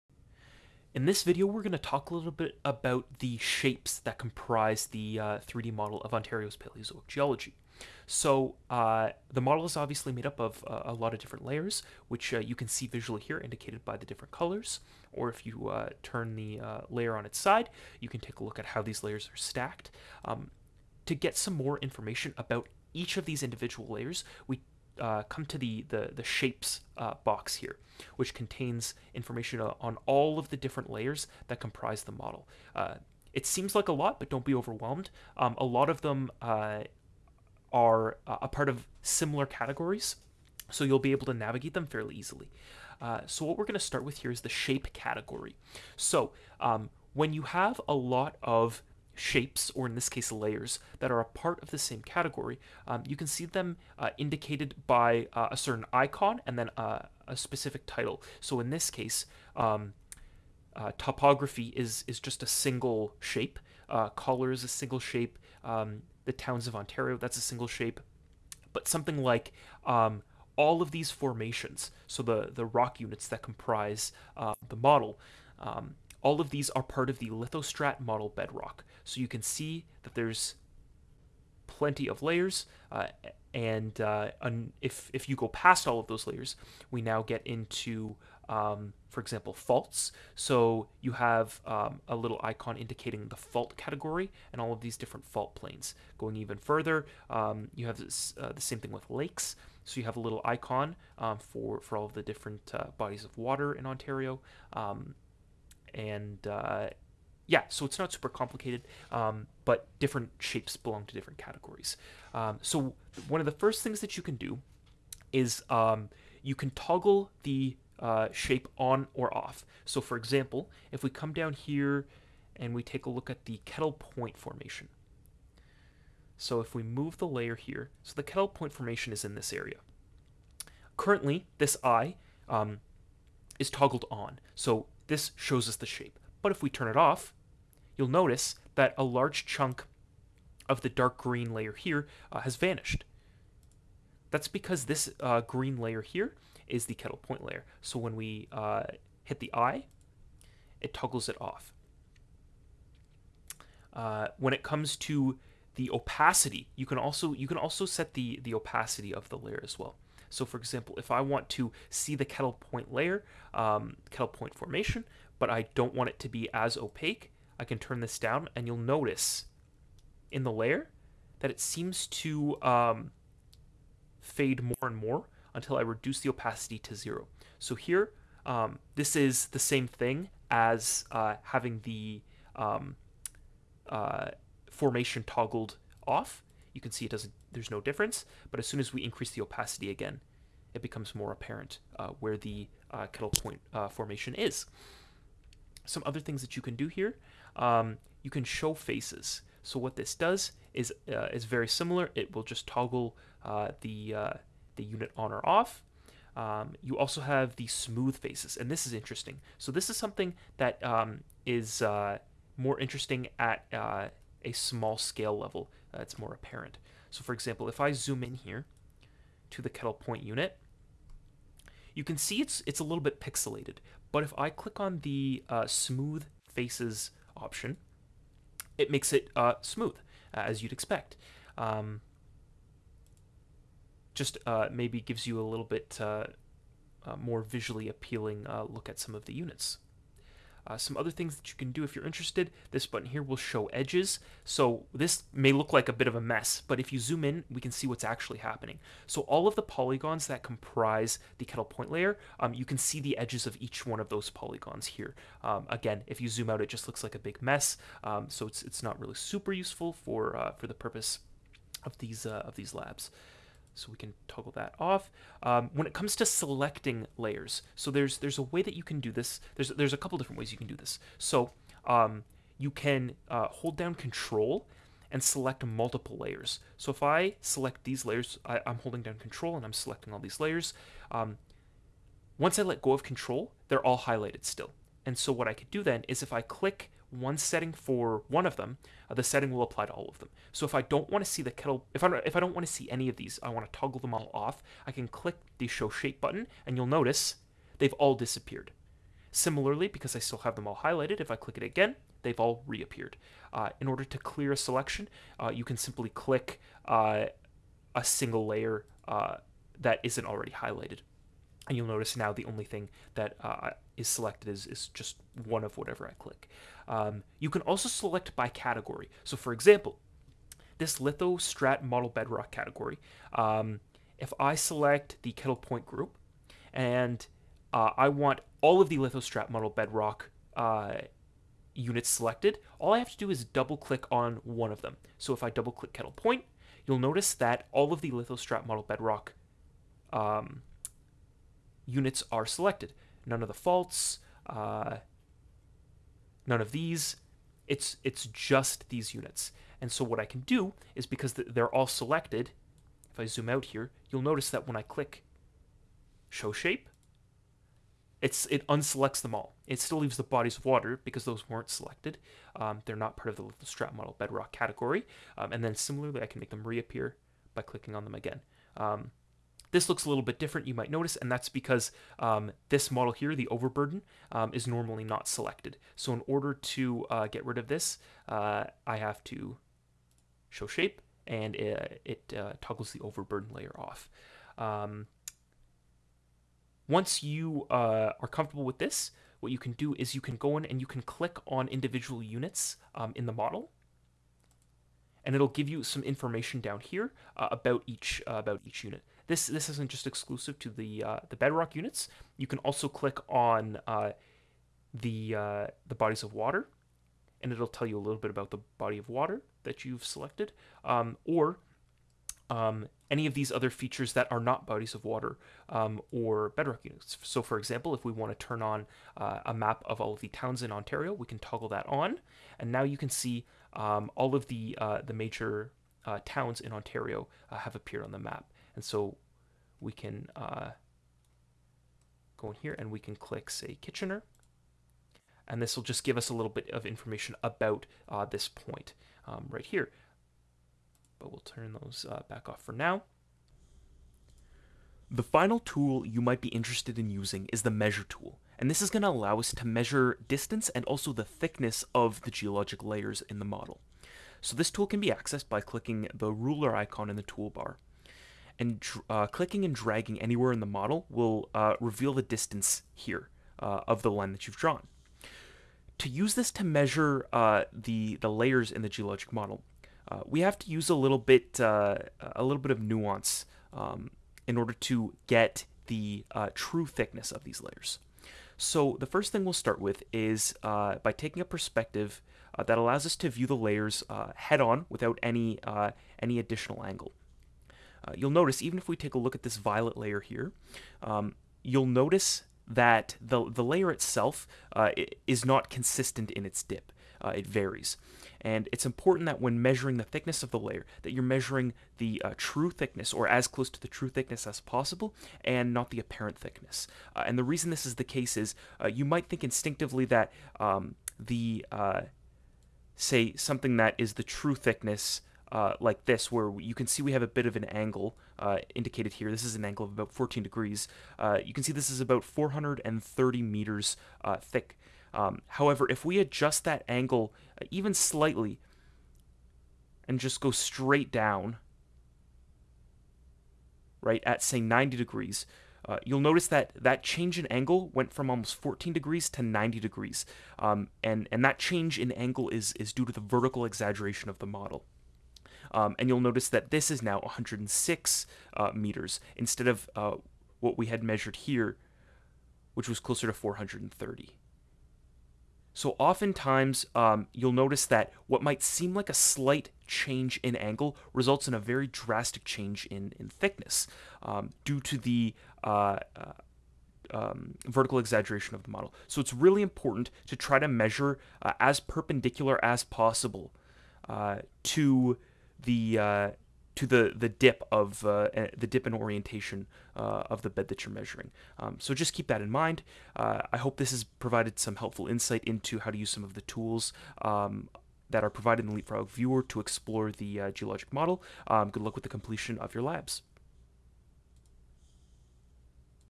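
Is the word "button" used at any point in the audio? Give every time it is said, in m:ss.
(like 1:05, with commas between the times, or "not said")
4:02, 4:56.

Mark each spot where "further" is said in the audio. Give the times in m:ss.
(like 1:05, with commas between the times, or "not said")
1:36.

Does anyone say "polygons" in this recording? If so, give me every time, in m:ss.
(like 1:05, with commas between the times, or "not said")
4:09, 4:14.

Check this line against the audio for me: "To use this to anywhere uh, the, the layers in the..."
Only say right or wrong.
wrong.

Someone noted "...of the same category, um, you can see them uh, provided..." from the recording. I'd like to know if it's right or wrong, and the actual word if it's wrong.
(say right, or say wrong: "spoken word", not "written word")
wrong: "indicated", not "provided".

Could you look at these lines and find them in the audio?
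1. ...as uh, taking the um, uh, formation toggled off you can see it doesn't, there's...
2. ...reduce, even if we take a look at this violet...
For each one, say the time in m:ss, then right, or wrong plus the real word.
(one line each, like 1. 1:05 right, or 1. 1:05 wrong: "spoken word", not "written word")
1. 3:00 wrong: "having", not "taking"
2. 8:08 wrong: "notice", not "reduce".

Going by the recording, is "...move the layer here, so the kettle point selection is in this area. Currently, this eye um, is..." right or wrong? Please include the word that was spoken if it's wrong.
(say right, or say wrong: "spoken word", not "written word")
wrong: "formation", not "selection".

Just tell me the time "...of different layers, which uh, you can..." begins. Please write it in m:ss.
0:11.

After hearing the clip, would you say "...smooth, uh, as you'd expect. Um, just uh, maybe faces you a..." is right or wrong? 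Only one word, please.
wrong.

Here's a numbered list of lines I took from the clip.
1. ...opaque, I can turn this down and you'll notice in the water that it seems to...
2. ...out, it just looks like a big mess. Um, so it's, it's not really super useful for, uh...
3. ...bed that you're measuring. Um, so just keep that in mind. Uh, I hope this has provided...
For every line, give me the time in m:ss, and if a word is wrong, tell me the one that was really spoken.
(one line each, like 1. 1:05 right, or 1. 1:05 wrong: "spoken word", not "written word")
1. 2:46 wrong: "layer", not "water"
2. 4:16 right
3. 9:40 right.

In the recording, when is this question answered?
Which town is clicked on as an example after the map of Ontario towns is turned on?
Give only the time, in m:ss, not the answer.
7:13.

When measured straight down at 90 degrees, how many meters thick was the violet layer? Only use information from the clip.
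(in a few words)
106 meters.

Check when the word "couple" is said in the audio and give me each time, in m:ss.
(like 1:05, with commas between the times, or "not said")
4:29.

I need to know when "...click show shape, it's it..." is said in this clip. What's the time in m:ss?
5:54.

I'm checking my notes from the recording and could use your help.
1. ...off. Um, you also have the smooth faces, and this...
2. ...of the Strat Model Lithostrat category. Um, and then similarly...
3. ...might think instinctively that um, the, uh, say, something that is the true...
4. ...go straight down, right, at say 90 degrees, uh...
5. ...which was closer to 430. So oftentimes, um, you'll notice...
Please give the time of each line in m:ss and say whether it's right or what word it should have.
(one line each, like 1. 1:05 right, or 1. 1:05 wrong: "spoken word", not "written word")
1. 3:25 right
2. 6:03 wrong: "Bedrock", not "Lithostrat"
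3. 8:29 right
4. 8:50 right
5. 9:12 right.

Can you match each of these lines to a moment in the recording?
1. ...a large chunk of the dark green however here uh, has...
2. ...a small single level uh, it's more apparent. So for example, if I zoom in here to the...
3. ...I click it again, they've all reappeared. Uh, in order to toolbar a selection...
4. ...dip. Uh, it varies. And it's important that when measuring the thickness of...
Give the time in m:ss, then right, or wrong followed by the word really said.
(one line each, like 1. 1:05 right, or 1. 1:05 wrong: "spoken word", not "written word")
1. 2:18 wrong: "layer", not "however"
2. 3:33 wrong: "scale", not "single"
3. 5:01 wrong: "clear", not "toolbar"
4. 8:16 right.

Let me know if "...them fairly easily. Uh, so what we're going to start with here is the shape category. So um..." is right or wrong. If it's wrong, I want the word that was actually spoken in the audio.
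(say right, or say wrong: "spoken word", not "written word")
right.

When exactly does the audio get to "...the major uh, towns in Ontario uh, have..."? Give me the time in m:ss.
7:05.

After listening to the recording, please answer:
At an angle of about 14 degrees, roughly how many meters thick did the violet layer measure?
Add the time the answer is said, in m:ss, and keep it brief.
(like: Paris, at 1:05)
430 meters, at 8:42.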